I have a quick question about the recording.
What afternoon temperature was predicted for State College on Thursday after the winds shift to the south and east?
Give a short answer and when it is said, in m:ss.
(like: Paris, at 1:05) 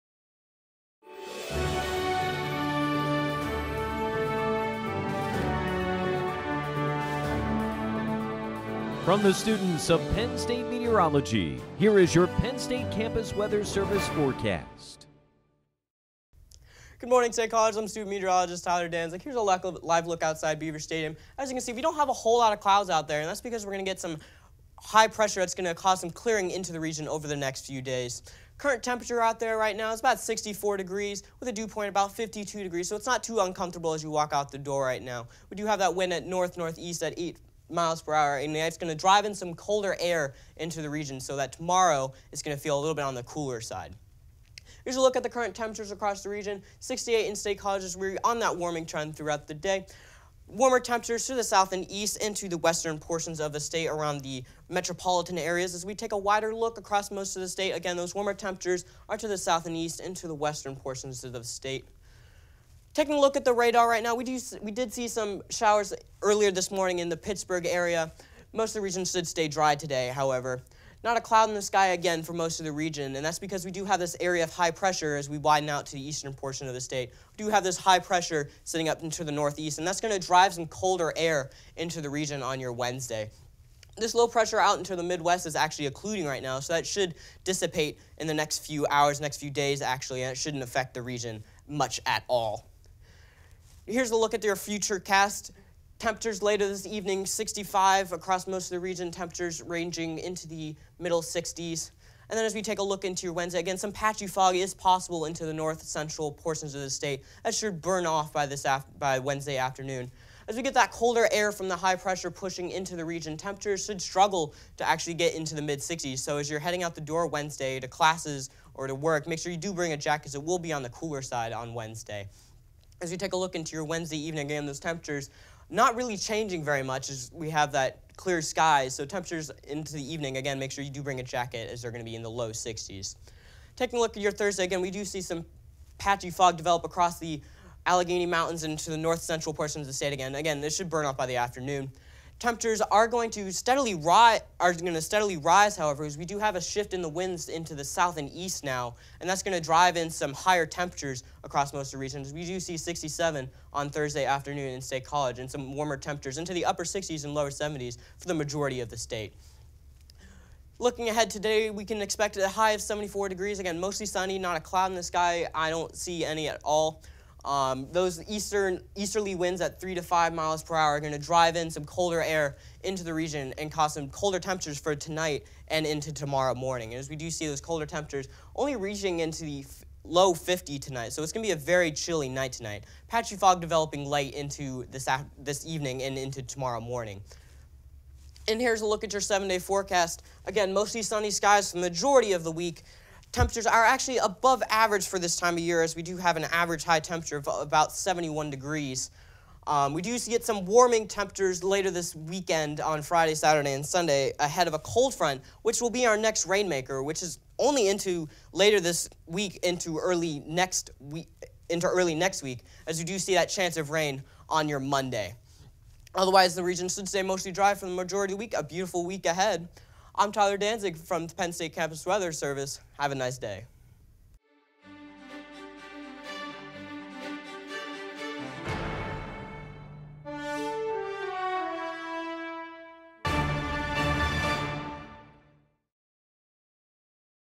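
67, at 2:32.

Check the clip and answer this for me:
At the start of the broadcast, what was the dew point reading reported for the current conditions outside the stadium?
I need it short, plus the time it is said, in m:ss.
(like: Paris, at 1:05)
52 degrees, at 0:32.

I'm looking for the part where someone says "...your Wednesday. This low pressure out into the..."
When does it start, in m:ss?
1:22.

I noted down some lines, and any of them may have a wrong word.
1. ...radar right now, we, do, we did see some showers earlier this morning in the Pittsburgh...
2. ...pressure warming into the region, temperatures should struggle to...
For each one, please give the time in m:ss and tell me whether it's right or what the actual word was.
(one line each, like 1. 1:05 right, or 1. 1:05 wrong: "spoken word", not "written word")
1. 1:03 right
2. 1:51 wrong: "pushing", not "warming".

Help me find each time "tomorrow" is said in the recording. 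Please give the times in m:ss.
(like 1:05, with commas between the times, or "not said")
0:41, 2:56, 3:06.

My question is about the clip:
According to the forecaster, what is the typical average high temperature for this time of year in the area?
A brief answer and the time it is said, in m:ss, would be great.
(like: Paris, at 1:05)
71 degrees, at 3:17.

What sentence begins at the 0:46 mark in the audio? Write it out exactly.
68 in-state colleges, we're on that warming trend throughout the day.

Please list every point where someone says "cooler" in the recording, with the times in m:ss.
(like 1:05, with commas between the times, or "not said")
0:43, 2:00.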